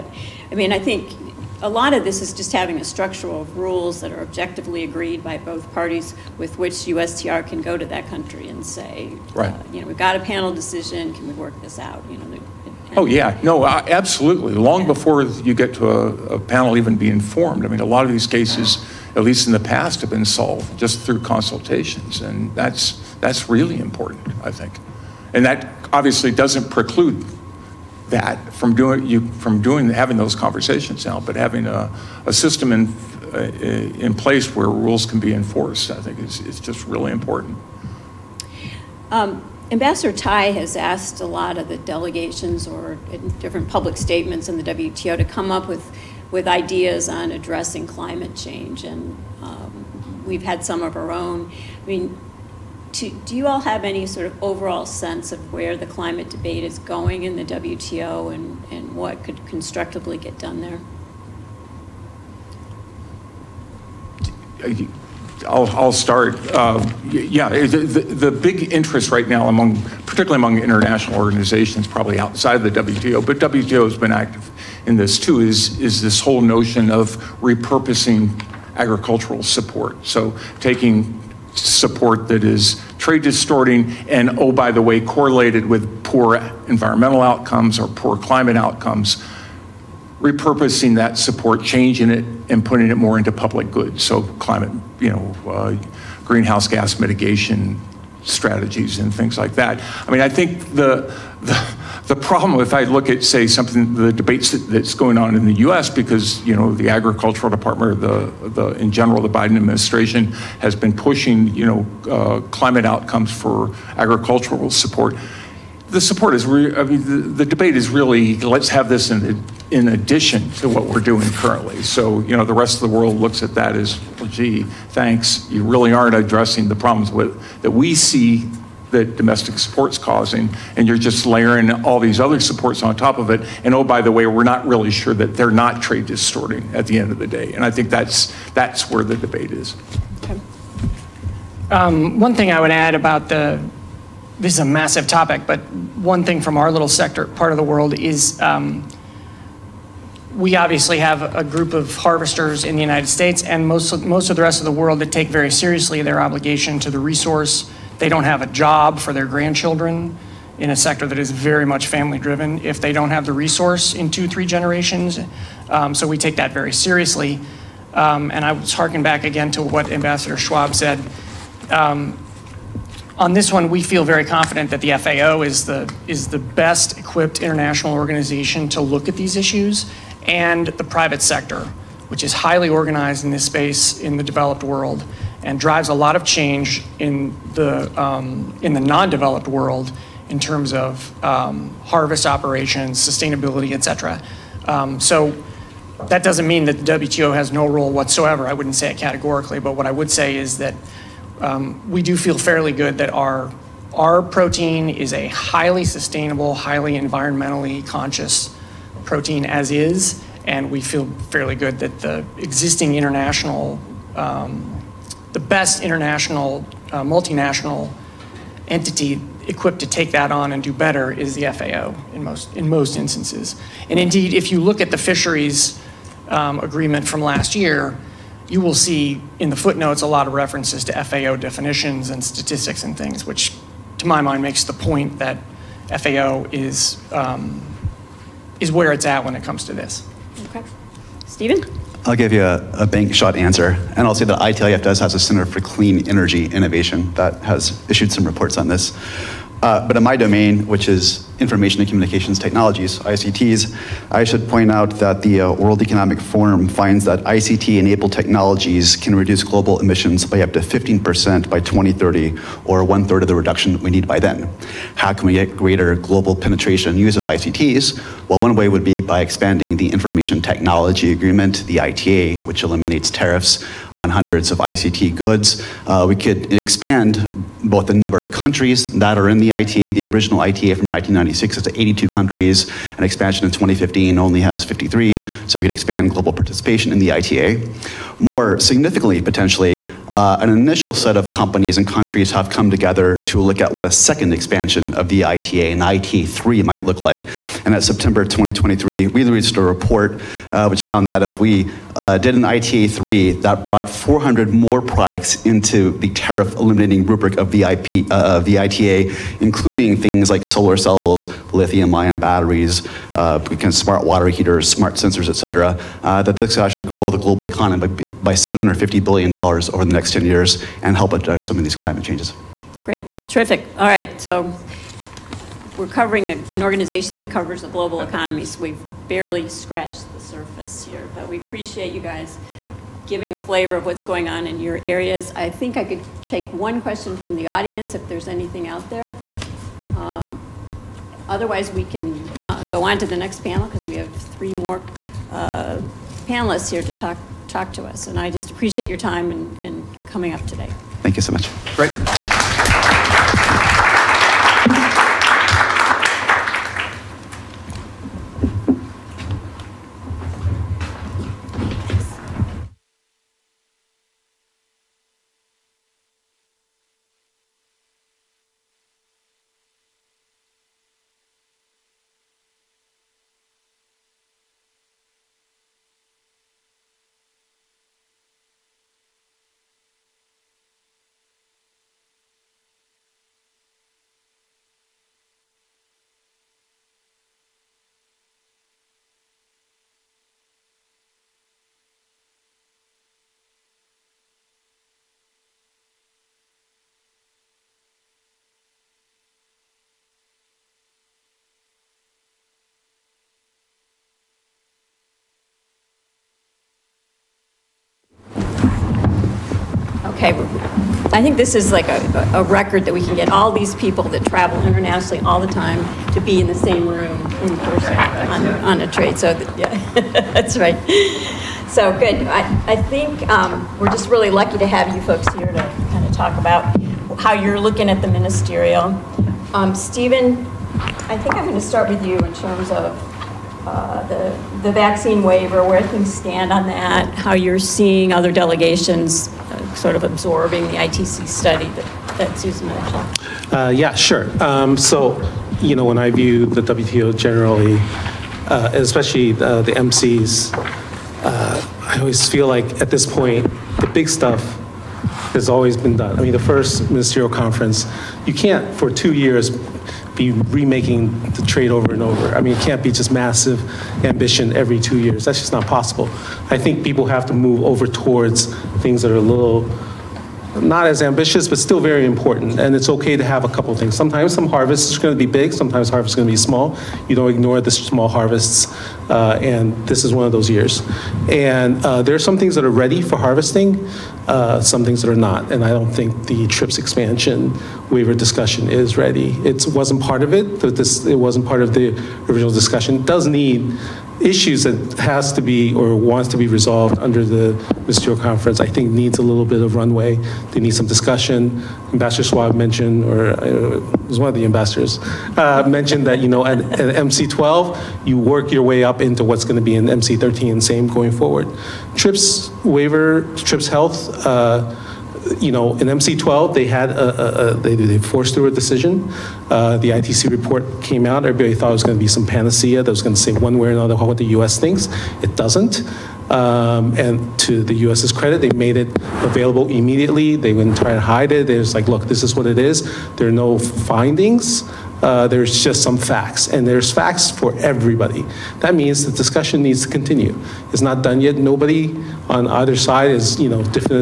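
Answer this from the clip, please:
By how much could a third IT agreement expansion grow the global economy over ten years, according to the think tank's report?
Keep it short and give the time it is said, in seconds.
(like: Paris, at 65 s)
$750 billion, at 318 s.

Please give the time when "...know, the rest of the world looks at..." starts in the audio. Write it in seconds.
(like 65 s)
122 s.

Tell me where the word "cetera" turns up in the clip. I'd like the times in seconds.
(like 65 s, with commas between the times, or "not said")
193 s, 315 s.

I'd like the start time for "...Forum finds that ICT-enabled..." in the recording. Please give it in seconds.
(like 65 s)
256 s.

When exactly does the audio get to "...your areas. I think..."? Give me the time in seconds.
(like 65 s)
334 s.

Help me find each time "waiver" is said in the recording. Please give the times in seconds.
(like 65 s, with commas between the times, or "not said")
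435 s, 487 s, 512 s.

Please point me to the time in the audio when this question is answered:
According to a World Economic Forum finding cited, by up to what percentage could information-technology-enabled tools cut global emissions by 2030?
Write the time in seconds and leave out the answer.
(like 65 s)
260 s.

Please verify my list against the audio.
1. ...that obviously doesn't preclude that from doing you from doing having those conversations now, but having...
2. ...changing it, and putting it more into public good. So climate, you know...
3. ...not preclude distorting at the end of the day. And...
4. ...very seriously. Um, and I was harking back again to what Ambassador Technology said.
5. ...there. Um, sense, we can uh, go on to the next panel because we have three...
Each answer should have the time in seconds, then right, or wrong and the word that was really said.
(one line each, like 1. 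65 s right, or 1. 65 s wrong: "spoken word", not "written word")
1. 25 s right
2. 91 s right
3. 135 s wrong: "trade", not "preclude"
4. 166 s wrong: "Schwab", not "Technology"
5. 338 s wrong: "otherwise", not "sense".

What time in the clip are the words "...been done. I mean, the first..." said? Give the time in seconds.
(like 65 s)
455 s.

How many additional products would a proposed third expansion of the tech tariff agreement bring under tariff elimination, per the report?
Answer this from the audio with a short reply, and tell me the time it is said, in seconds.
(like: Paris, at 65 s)
400, at 303 s.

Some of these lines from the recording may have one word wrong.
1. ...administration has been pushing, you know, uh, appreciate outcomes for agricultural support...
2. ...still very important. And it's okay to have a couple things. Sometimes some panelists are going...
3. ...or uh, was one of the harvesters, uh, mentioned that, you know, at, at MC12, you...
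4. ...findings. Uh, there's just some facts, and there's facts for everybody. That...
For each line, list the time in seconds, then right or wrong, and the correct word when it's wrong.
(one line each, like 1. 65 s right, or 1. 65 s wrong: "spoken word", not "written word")
1. 109 s wrong: "climate", not "appreciate"
2. 471 s wrong: "harvests", not "panelists"
3. 503 s wrong: "ambassadors", not "harvesters"
4. 533 s right.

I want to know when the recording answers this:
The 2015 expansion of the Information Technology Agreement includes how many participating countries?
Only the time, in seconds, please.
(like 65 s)
284 s.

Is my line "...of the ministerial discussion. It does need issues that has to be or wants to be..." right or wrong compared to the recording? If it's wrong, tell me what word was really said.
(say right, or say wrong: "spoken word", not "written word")
wrong: "original", not "ministerial".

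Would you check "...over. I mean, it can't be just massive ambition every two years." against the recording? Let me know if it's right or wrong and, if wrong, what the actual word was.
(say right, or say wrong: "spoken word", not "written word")
right.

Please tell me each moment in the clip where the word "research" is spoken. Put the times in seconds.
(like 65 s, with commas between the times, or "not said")
not said.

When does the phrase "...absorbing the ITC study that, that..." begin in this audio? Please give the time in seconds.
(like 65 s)
440 s.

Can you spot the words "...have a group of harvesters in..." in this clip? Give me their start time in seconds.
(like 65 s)
150 s.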